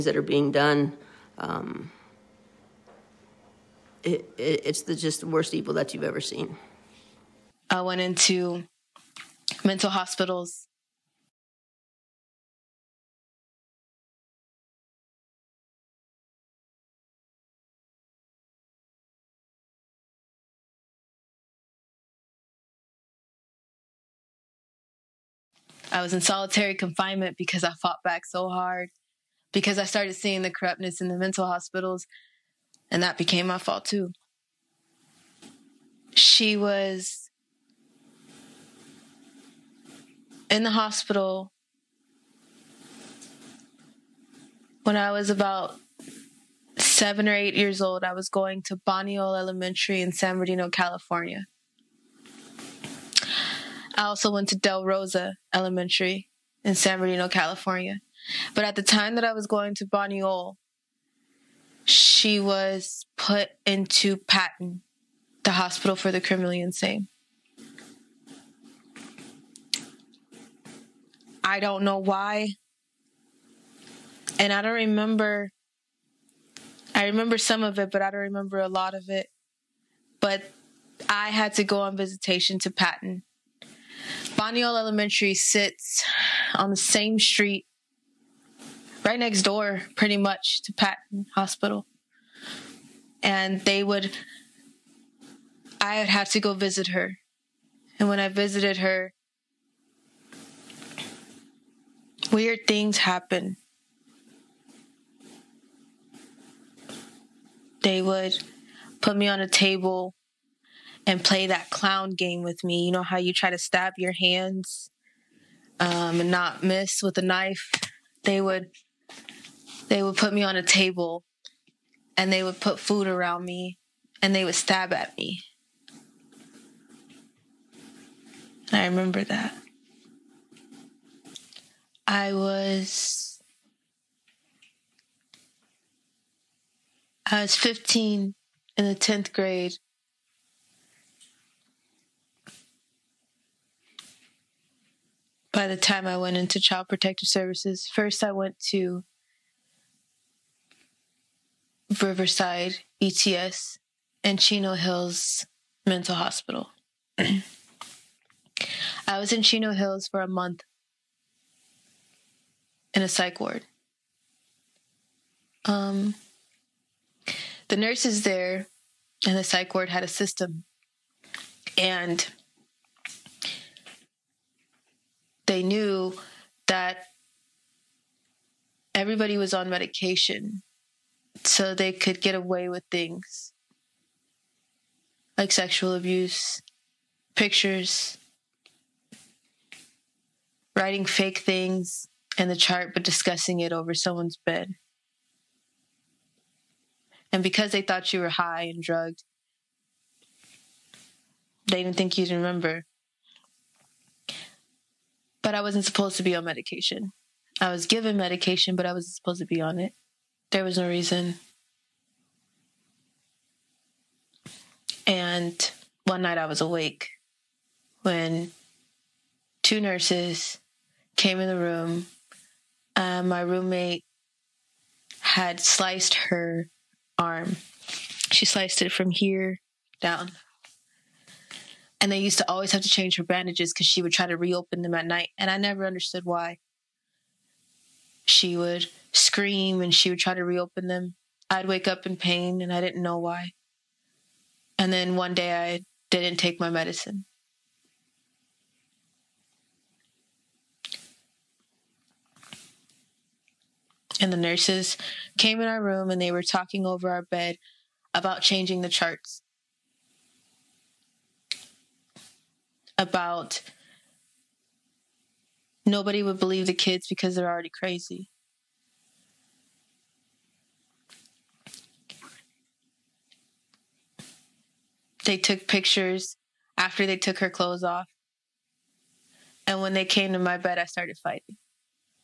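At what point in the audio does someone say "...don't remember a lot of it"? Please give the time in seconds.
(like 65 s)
78 s.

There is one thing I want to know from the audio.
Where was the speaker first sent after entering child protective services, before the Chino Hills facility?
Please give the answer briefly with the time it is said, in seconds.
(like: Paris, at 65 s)
Riverside ETS, at 152 s.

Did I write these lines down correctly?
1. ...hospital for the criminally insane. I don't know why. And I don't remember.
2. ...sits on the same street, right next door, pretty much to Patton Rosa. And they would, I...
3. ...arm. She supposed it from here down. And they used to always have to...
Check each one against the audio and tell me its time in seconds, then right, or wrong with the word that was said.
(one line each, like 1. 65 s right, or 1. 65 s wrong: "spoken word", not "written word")
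1. 65 s right
2. 85 s wrong: "Hospital", not "Rosa"
3. 227 s wrong: "sliced", not "supposed".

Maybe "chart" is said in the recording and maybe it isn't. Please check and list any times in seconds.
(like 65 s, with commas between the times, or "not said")
192 s, 258 s.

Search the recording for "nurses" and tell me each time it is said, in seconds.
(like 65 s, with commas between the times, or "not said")
167 s, 219 s, 254 s.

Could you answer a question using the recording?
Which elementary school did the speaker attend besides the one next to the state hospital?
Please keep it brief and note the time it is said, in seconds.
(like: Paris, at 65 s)
Del Rosa Elementary, at 54 s.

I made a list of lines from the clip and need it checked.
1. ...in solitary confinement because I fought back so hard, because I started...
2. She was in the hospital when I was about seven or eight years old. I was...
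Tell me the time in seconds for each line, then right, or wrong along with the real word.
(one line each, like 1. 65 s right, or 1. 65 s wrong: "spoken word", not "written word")
1. 26 s right
2. 36 s right.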